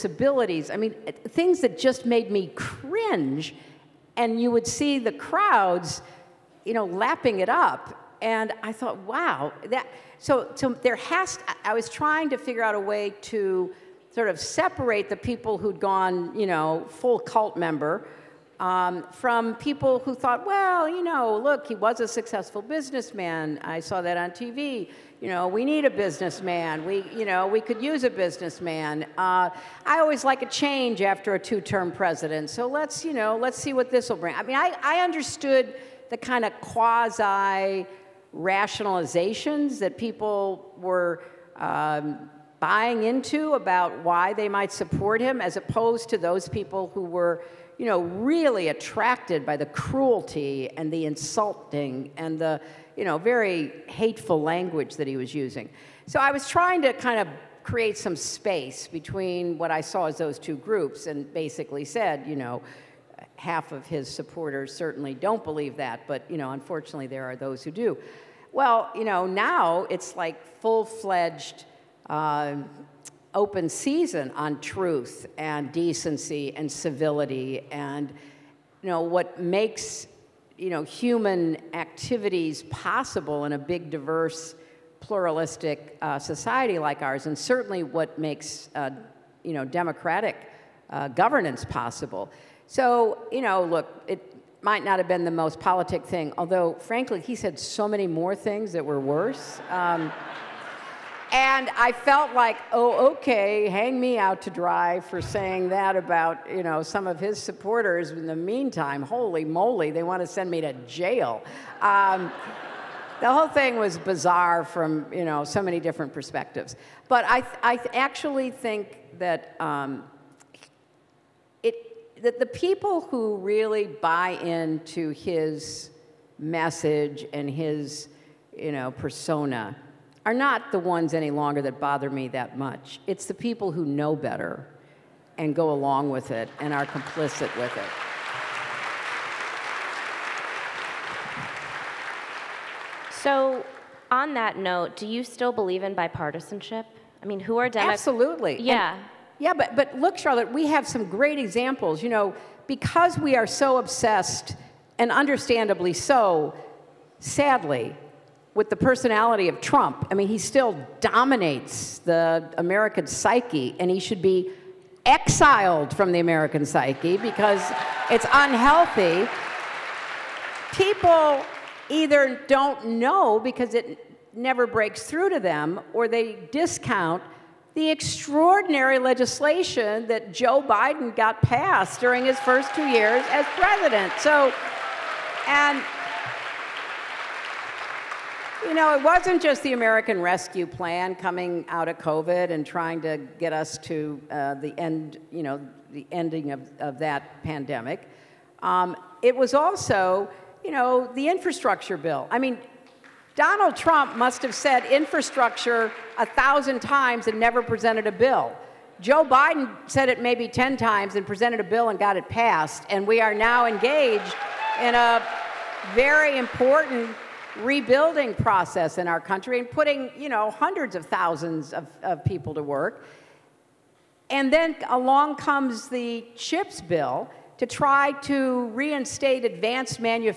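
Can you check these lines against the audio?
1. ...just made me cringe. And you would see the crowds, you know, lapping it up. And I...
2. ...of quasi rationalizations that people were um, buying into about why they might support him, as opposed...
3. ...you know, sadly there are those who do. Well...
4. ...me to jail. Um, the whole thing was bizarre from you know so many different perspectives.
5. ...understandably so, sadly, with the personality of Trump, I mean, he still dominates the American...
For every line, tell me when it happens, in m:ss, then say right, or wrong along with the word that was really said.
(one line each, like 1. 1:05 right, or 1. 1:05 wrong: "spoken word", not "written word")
1. 0:01 right
2. 0:36 right
3. 1:06 wrong: "unfortunately", not "sadly"
4. 1:50 right
5. 2:35 right.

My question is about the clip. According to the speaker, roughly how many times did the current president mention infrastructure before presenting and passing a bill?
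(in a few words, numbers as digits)
10.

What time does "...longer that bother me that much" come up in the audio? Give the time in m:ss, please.
2:11.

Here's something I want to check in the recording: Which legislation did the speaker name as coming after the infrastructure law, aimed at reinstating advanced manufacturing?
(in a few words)
CHIPS bill.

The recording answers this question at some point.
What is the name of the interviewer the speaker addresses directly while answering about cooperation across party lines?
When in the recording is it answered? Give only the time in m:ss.
2:30.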